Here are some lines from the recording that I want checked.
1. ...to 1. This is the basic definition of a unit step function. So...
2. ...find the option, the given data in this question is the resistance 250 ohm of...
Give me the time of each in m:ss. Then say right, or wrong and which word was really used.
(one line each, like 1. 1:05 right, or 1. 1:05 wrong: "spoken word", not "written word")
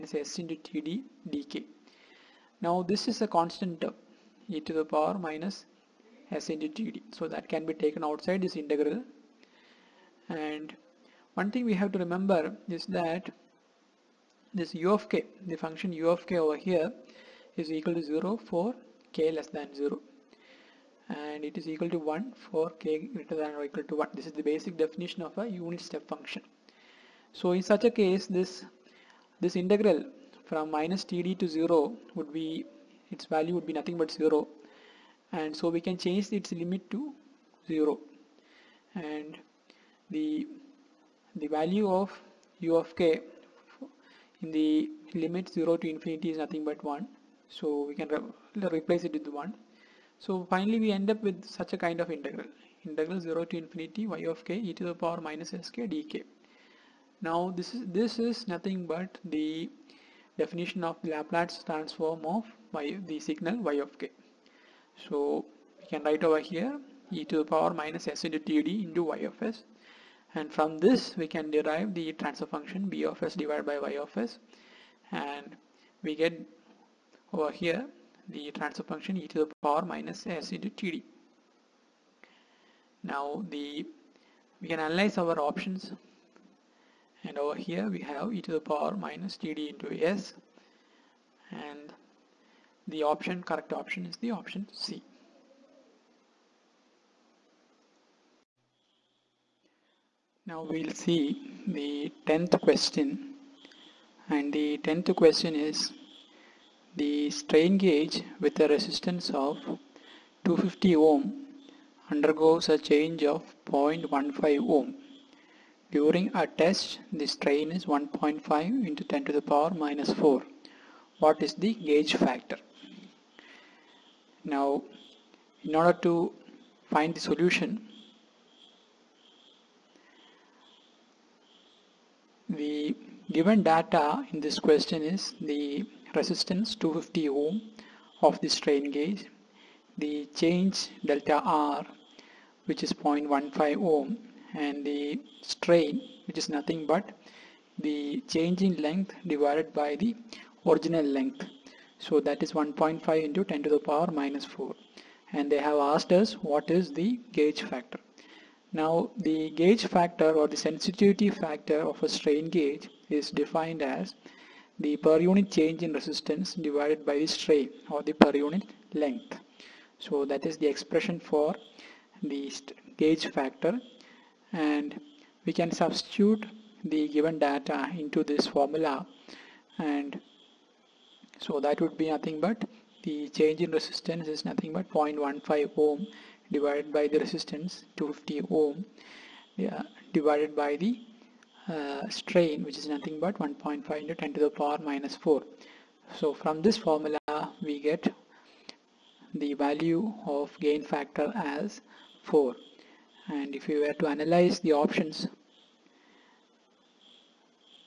1. 0:23 right
2. 2:06 wrong: "solution", not "option".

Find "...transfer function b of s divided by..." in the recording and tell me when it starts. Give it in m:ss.
1:12.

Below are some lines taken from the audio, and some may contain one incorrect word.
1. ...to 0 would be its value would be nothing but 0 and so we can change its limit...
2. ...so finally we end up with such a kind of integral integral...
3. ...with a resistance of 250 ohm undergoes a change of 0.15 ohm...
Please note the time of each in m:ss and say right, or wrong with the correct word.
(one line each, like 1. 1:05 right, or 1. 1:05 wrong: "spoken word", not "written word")
1. 0:31 right
2. 0:50 right
3. 1:48 right.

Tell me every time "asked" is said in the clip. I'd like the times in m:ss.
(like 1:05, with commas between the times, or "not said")
2:35.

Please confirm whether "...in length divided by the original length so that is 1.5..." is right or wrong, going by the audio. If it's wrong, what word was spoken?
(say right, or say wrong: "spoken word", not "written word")
right.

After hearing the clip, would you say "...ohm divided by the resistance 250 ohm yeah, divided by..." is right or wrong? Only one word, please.
right.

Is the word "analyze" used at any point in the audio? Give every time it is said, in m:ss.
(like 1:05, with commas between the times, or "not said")
1:24, 3:24.